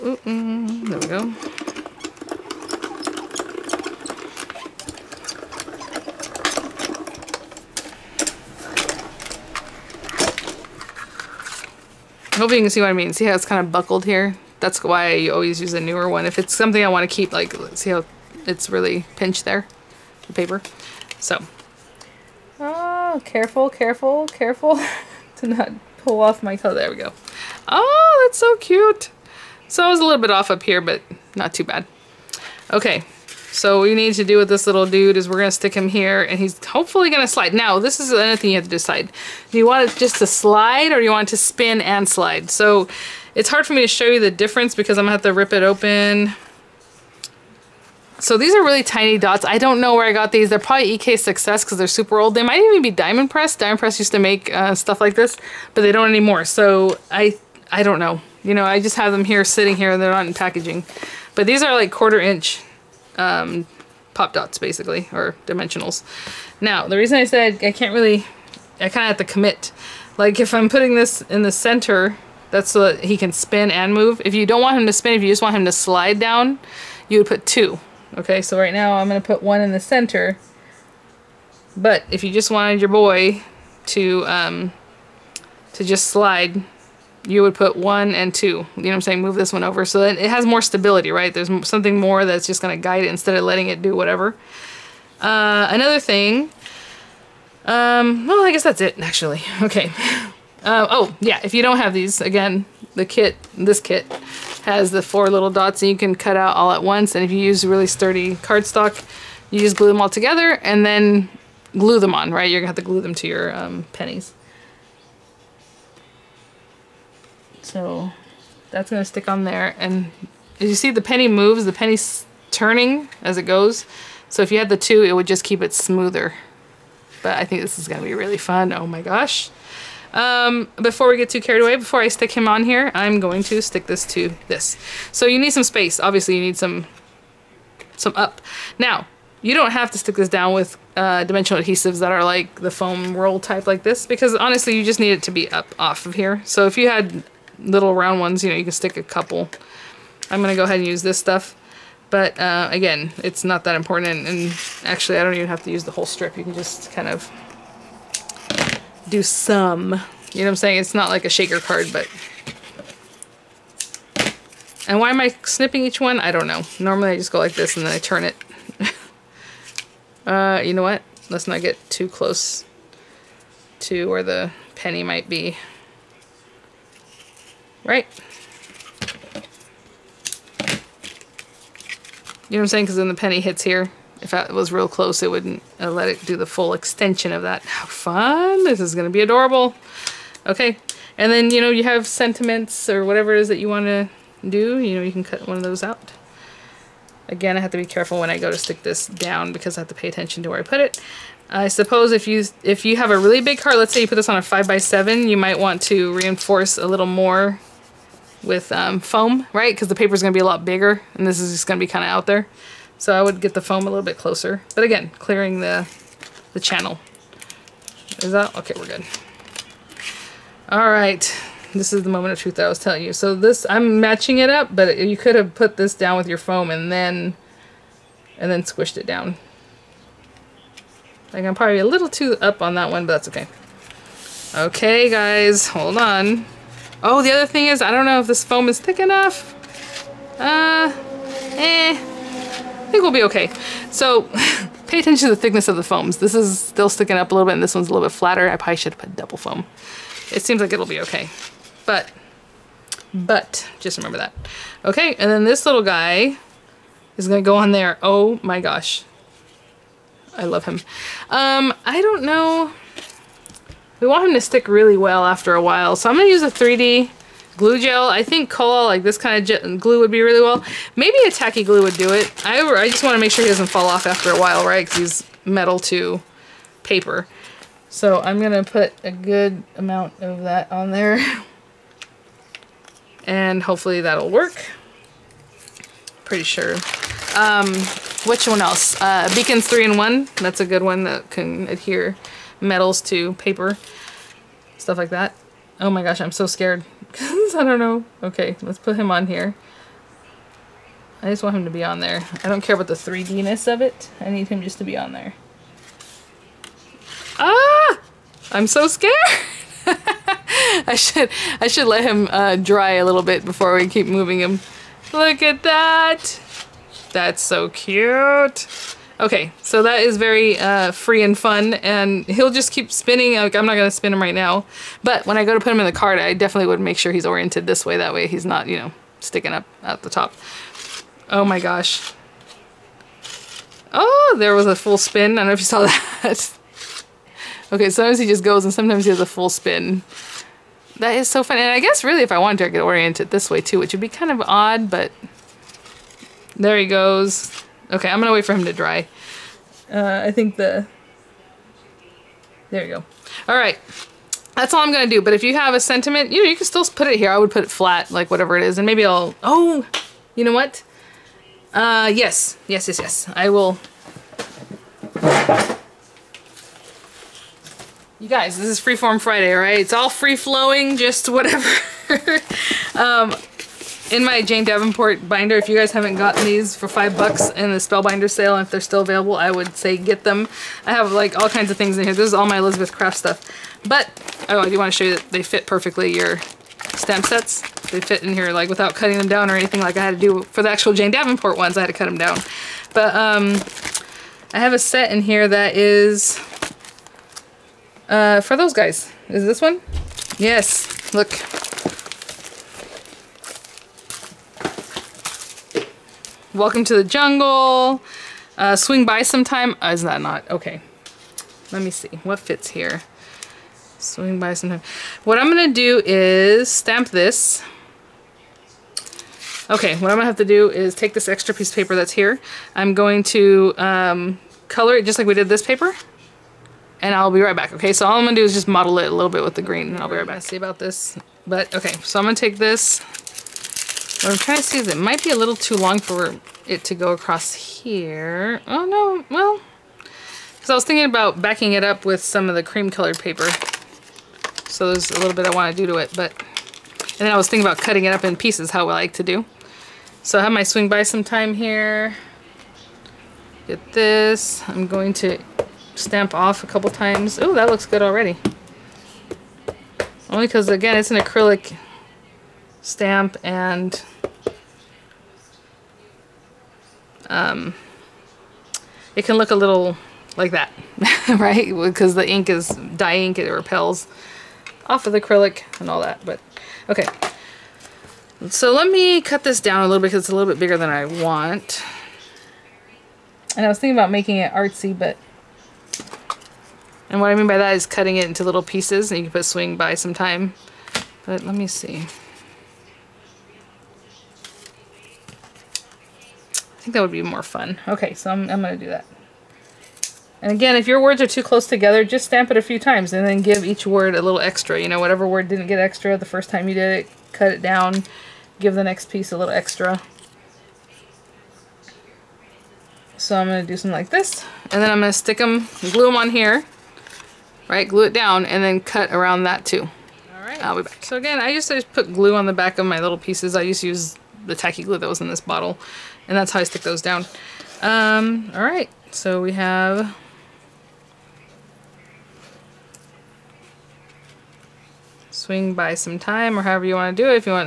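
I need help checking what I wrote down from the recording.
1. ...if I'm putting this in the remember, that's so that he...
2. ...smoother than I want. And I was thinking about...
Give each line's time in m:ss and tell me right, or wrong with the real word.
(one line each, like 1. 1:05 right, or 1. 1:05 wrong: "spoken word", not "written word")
1. 1:10 wrong: "center", not "remember"
2. 8:00 wrong: "bigger", not "smoother".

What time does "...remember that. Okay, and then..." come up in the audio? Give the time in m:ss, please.
4:13.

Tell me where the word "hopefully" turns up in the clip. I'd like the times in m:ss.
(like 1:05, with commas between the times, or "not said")
0:36, 4:43.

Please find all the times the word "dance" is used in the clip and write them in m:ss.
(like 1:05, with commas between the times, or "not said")
not said.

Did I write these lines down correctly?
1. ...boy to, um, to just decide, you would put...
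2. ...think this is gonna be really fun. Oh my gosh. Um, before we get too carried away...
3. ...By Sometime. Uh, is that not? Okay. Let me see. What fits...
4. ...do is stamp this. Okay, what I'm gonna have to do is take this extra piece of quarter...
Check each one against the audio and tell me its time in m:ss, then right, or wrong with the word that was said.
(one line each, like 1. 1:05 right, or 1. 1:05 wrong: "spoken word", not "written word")
1. 1:22 wrong: "slide", not "decide"
2. 2:07 right
3. 6:49 right
4. 6:55 wrong: "paper", not "quarter".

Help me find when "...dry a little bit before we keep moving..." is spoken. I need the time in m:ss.
5:12.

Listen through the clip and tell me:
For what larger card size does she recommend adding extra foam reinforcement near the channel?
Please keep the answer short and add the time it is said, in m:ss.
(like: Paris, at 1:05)
5 by 7, at 3:24.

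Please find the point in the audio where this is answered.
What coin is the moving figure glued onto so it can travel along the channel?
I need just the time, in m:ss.
1:53.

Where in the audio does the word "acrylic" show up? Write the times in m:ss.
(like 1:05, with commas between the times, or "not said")
7:41, 7:55.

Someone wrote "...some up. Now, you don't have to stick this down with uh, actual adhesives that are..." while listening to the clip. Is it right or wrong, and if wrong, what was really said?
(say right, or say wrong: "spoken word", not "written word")
wrong: "dimensional", not "actual".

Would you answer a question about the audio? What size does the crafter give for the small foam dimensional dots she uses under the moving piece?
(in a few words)
quarter inch.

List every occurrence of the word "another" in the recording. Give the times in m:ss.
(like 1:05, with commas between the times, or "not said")
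0:38, 1:35.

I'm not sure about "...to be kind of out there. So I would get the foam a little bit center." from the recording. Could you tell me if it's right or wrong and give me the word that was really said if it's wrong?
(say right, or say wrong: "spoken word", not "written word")
wrong: "closer", not "center".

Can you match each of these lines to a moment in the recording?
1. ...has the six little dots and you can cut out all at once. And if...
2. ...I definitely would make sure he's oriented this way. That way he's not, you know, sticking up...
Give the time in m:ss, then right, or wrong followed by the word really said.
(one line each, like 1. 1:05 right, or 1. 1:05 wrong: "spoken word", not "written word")
1. 1:44 wrong: "four", not "six"
2. 5:26 right.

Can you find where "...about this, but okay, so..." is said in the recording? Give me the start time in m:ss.
7:10.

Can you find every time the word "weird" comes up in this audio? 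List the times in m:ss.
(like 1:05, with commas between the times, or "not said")
not said.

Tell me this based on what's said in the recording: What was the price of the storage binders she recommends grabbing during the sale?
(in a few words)
five bucks.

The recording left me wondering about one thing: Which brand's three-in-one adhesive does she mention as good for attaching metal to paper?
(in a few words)
Beacons 3 in 1.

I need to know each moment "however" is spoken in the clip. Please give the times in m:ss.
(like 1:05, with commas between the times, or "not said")
8:56.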